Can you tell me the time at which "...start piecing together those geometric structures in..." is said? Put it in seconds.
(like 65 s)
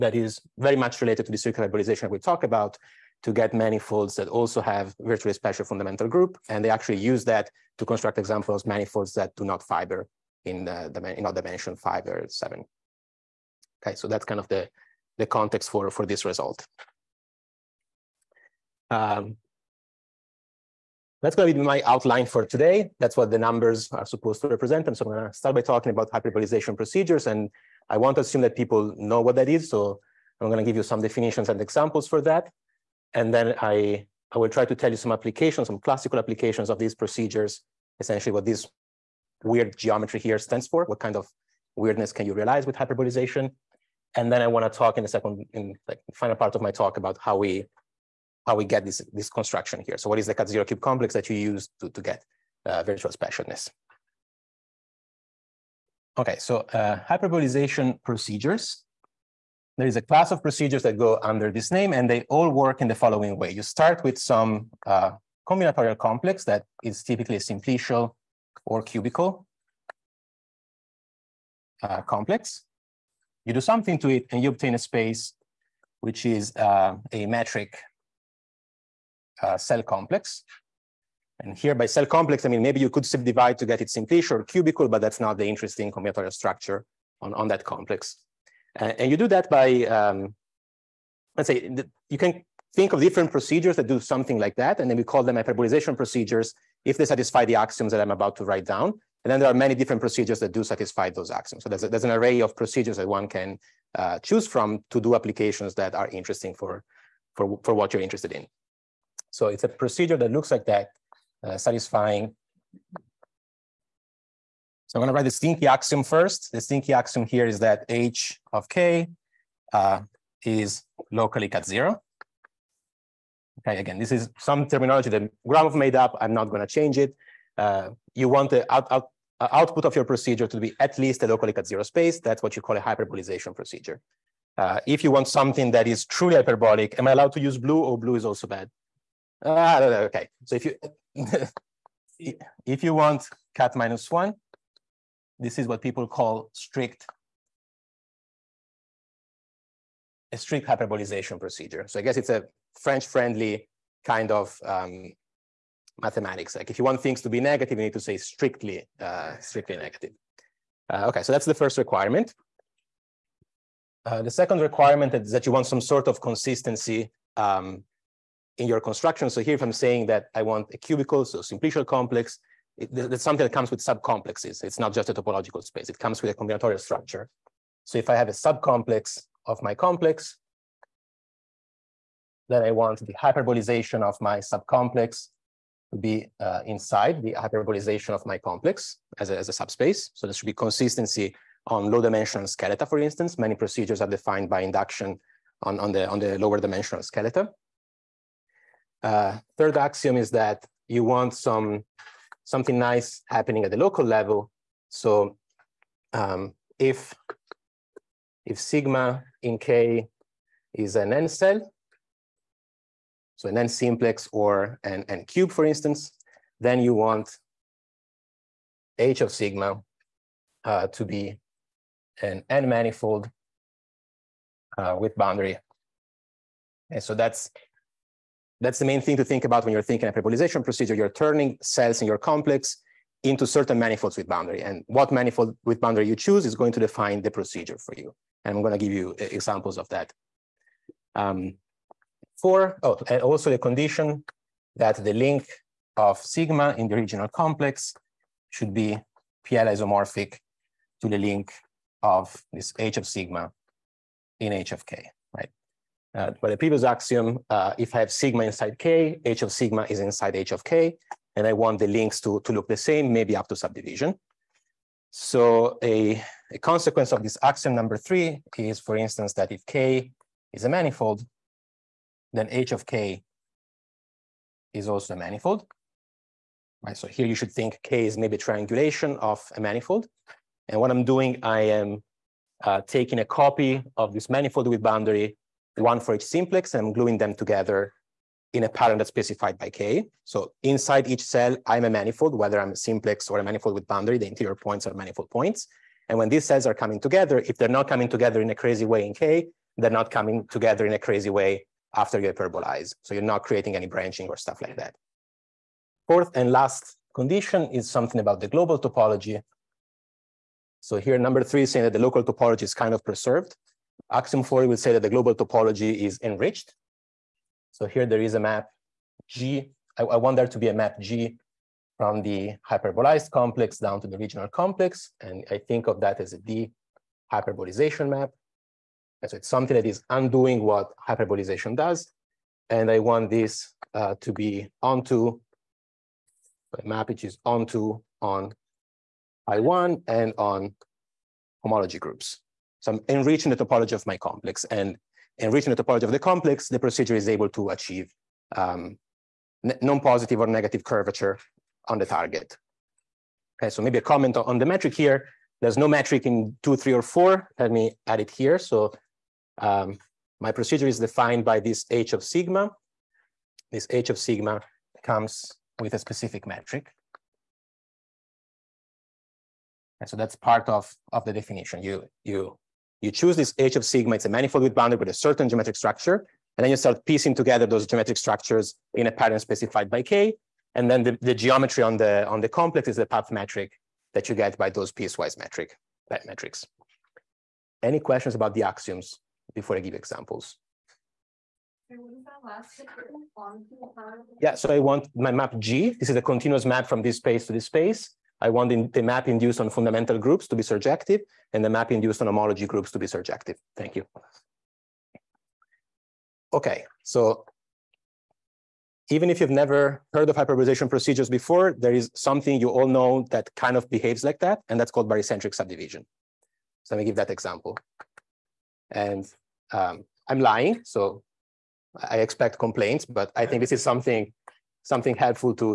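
376 s.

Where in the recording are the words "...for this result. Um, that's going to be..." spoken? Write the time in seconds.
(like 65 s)
15 s.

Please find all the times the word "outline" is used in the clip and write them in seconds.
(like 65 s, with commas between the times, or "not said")
21 s.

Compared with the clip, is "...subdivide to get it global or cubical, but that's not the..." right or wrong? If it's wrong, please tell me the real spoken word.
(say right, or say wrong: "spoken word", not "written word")
wrong: "simplicial", not "global".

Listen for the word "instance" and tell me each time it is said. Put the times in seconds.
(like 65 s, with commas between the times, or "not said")
192 s, 215 s, 268 s.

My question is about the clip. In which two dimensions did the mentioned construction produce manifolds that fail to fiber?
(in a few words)
5 or 7.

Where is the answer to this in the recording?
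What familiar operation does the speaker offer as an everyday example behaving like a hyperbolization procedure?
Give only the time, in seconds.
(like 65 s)
415 s.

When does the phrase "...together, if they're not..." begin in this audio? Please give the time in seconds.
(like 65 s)
296 s.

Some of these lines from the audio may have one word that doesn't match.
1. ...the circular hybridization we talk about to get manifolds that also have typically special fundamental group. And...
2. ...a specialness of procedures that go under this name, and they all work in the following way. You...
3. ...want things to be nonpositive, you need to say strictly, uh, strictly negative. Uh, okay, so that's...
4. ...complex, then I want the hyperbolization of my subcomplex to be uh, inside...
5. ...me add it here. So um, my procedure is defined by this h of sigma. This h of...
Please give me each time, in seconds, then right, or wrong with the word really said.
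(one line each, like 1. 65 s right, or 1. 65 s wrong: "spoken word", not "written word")
1. 1 s wrong: "virtually", not "typically"
2. 59 s wrong: "class", not "specialness"
3. 156 s wrong: "negative", not "nonpositive"
4. 179 s right
5. 357 s right.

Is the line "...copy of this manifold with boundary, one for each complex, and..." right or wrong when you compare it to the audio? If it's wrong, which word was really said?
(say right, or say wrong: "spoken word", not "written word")
wrong: "simplex", not "complex".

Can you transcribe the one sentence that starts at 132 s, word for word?
That's what you call a hyperbolization procedure.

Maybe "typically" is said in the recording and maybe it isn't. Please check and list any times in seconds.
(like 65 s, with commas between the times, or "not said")
67 s.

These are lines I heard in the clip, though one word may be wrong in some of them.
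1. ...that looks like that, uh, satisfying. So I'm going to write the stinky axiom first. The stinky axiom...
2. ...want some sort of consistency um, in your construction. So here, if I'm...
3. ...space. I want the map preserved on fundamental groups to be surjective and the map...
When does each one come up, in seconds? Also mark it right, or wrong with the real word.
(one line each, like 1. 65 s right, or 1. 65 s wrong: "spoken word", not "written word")
1. 110 s right
2. 165 s right
3. 397 s wrong: "induced", not "preserved".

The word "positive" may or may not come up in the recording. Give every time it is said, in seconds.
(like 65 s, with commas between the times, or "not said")
349 s.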